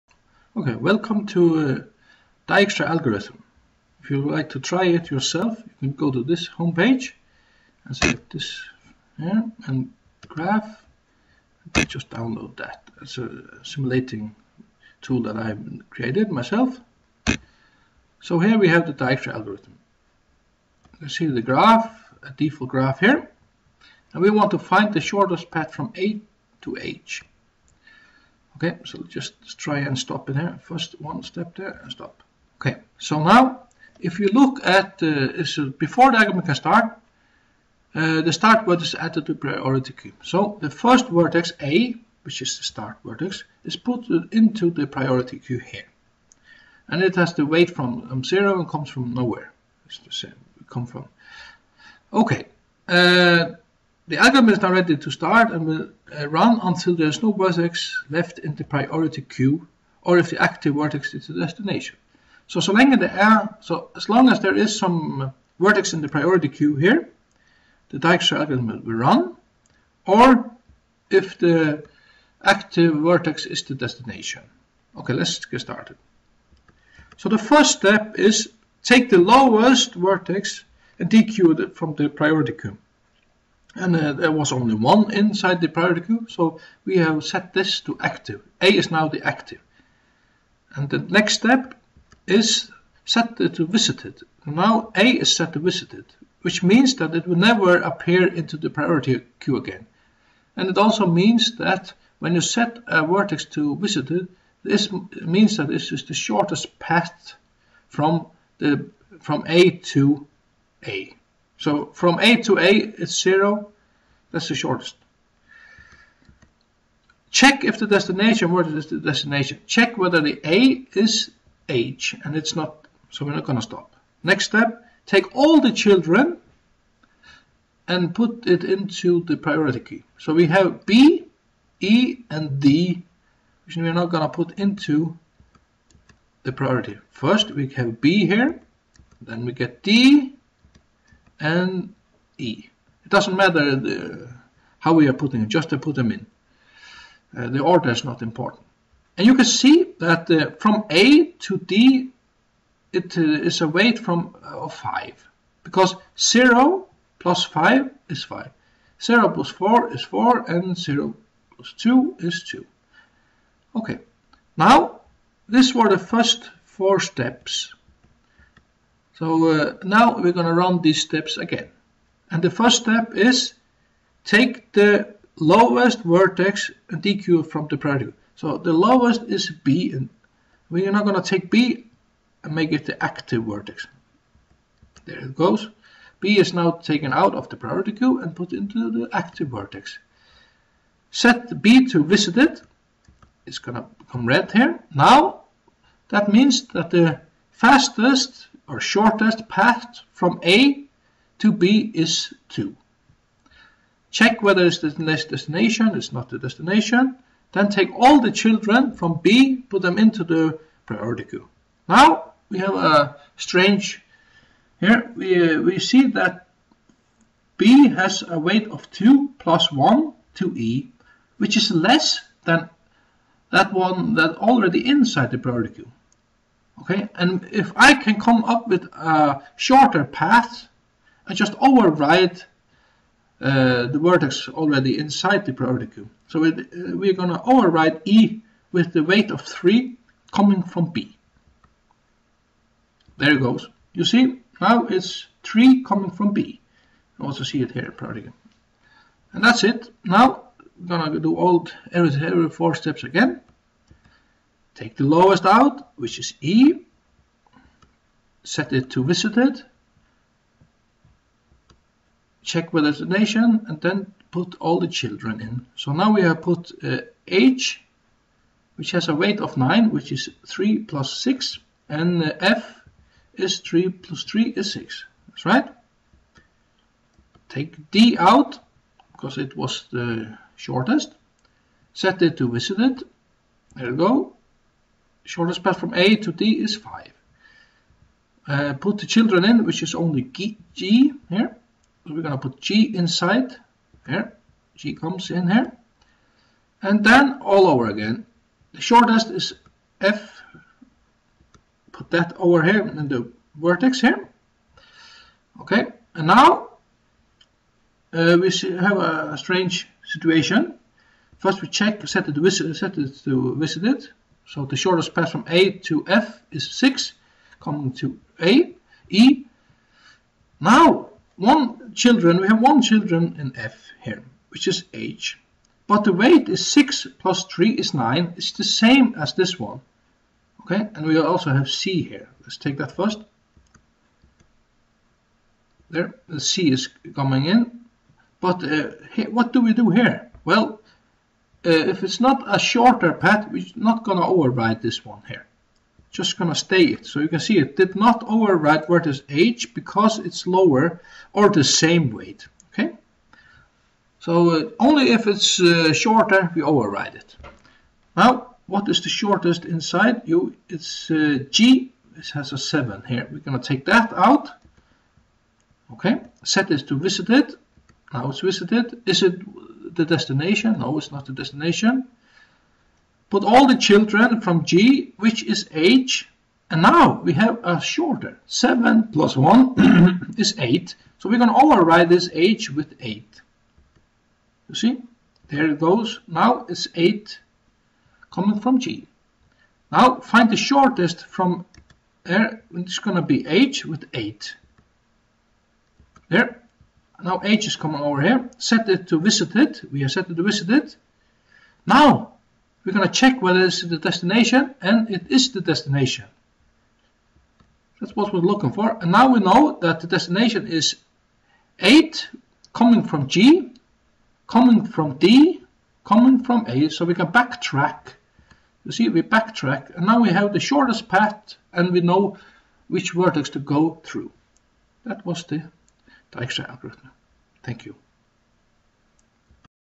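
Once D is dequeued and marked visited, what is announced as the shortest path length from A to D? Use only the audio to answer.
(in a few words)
5.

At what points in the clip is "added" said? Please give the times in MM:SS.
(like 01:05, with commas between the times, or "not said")
00:38.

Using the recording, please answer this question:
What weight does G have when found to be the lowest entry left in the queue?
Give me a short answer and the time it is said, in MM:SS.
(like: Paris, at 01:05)
7, at 06:02.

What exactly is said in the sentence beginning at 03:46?
Okay, and if I can come up with a shorter path, I just overwrite uh, the vertex already inside the priority queue.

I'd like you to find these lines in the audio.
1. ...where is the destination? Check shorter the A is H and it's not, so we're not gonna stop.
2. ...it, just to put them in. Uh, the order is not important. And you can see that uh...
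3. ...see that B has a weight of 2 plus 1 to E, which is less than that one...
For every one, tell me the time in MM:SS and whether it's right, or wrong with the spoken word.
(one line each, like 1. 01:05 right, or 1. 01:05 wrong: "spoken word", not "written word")
1. 01:58 wrong: "whether", not "shorter"
2. 02:25 right
3. 03:35 right.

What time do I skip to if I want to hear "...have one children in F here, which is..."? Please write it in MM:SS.
05:22.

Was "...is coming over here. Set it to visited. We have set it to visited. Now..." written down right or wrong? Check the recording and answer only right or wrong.
right.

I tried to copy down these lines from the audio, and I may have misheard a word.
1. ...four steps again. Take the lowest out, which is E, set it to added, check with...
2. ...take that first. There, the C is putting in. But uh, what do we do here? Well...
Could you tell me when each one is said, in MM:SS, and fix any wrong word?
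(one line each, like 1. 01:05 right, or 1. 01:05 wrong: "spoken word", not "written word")
1. 04:12 wrong: "visited", not "added"
2. 05:32 wrong: "coming", not "putting".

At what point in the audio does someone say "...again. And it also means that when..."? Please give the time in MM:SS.
01:39.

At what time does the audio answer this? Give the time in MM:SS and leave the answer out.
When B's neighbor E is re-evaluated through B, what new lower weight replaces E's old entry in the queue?
03:59.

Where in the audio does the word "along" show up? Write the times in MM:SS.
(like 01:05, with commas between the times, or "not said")
not said.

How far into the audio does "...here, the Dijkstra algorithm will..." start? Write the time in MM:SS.
01:06.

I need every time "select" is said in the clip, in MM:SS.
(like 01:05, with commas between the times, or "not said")
00:07.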